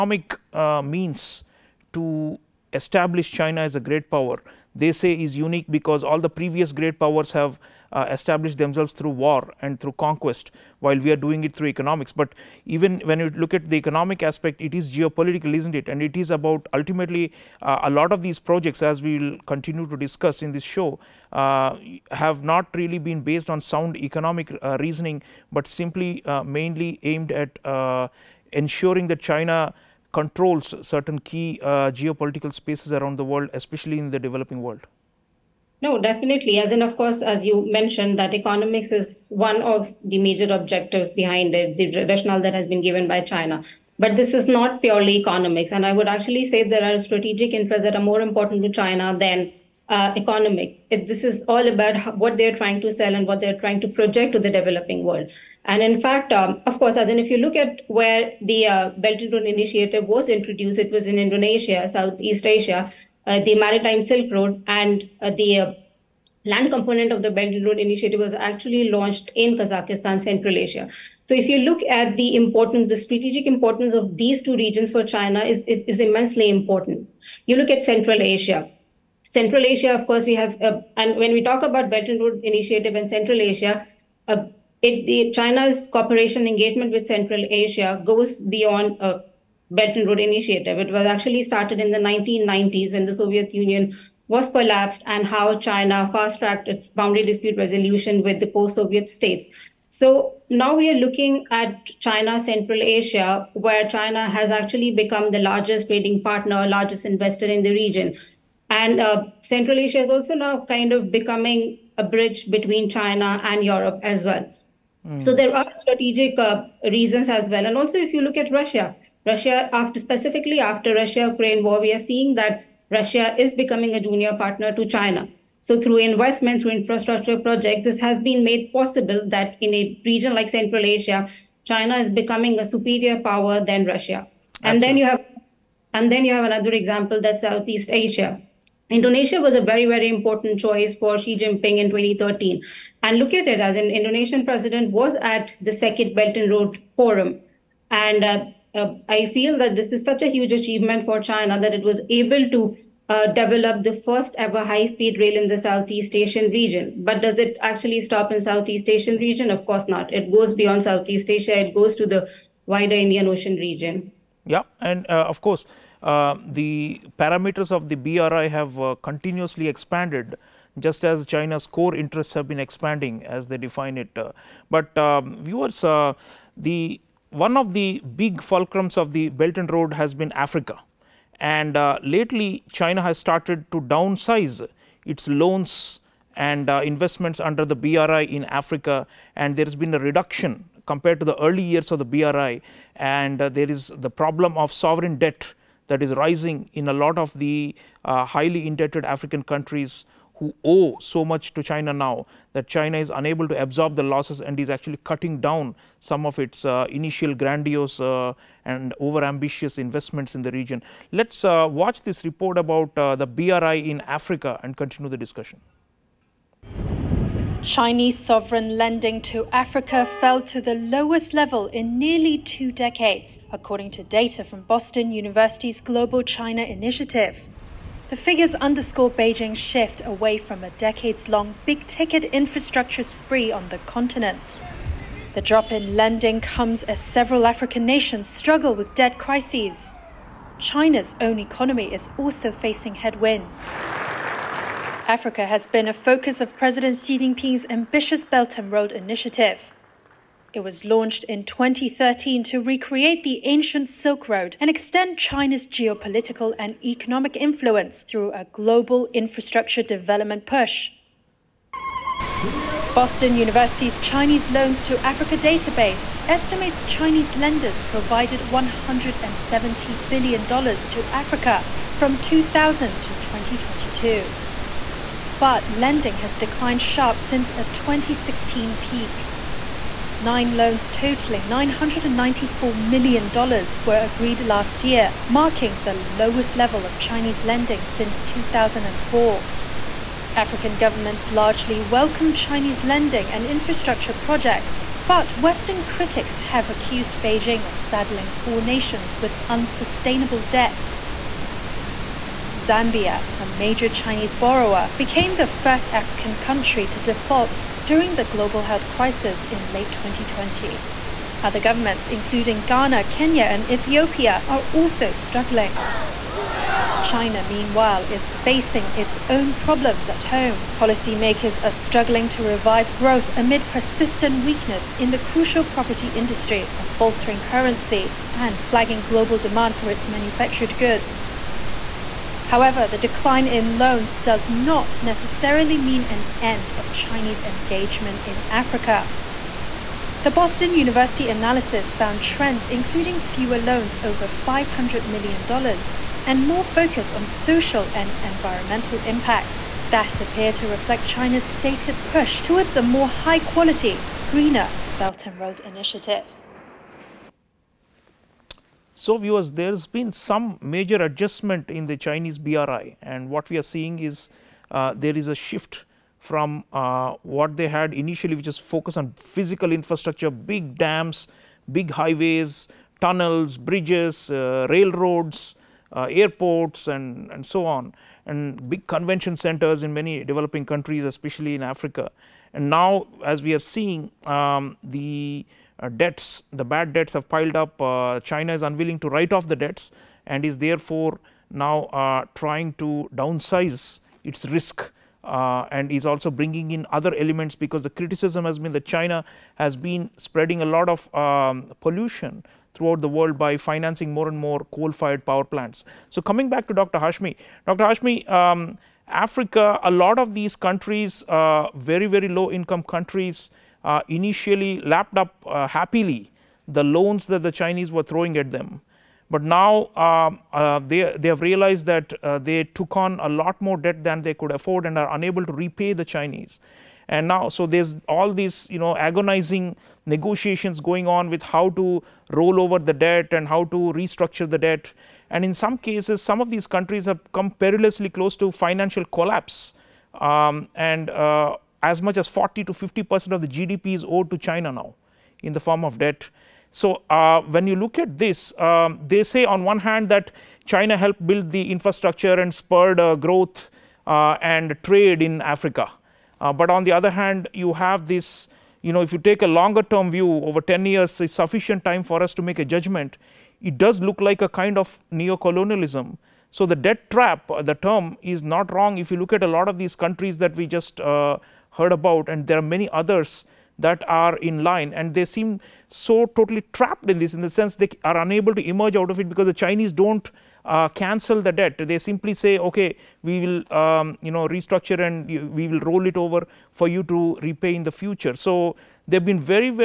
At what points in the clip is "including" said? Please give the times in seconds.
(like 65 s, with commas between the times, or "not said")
312 s, 342 s.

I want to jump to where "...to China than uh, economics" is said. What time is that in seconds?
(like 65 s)
48 s.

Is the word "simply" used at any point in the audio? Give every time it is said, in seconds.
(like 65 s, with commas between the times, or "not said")
25 s, 481 s.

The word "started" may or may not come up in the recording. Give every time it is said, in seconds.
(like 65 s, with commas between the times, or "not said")
91 s, 183 s.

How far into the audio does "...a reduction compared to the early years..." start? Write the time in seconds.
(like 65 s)
189 s.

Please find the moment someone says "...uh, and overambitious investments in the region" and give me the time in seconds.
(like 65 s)
207 s.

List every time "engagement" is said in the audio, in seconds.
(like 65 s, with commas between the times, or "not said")
86 s, 337 s.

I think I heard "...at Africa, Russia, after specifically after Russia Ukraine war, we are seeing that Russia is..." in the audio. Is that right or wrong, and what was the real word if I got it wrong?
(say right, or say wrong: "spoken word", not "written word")
wrong: "Russia", not "Africa".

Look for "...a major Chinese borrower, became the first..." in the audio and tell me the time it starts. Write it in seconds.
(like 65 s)
303 s.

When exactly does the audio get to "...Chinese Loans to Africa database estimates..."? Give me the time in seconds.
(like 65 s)
263 s.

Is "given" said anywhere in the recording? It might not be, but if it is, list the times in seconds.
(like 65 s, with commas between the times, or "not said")
42 s.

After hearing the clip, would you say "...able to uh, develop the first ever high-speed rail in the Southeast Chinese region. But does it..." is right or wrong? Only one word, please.
wrong.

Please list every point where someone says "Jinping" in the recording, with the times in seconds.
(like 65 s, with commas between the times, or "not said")
141 s, 247 s.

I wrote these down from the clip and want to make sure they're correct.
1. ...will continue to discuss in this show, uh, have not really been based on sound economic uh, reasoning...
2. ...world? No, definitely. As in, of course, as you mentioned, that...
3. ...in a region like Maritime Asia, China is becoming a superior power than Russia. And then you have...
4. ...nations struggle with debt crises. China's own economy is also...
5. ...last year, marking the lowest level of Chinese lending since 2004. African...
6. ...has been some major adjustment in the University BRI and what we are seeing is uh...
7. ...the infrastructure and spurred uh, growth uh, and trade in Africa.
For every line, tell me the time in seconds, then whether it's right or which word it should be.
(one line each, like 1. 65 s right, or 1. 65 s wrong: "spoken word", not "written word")
1. 19 s right
2. 34 s right
3. 129 s wrong: "Central", not "Maritime"
4. 237 s right
5. 284 s right
6. 359 s wrong: "Chinese", not "University"
7. 451 s right.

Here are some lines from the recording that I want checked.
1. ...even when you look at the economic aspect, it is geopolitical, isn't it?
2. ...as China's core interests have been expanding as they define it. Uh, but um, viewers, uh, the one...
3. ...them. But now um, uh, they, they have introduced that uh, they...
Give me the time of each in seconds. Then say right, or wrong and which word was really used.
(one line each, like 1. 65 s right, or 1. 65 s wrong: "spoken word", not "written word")
1. 12 s right
2. 171 s right
3. 418 s wrong: "realized", not "introduced".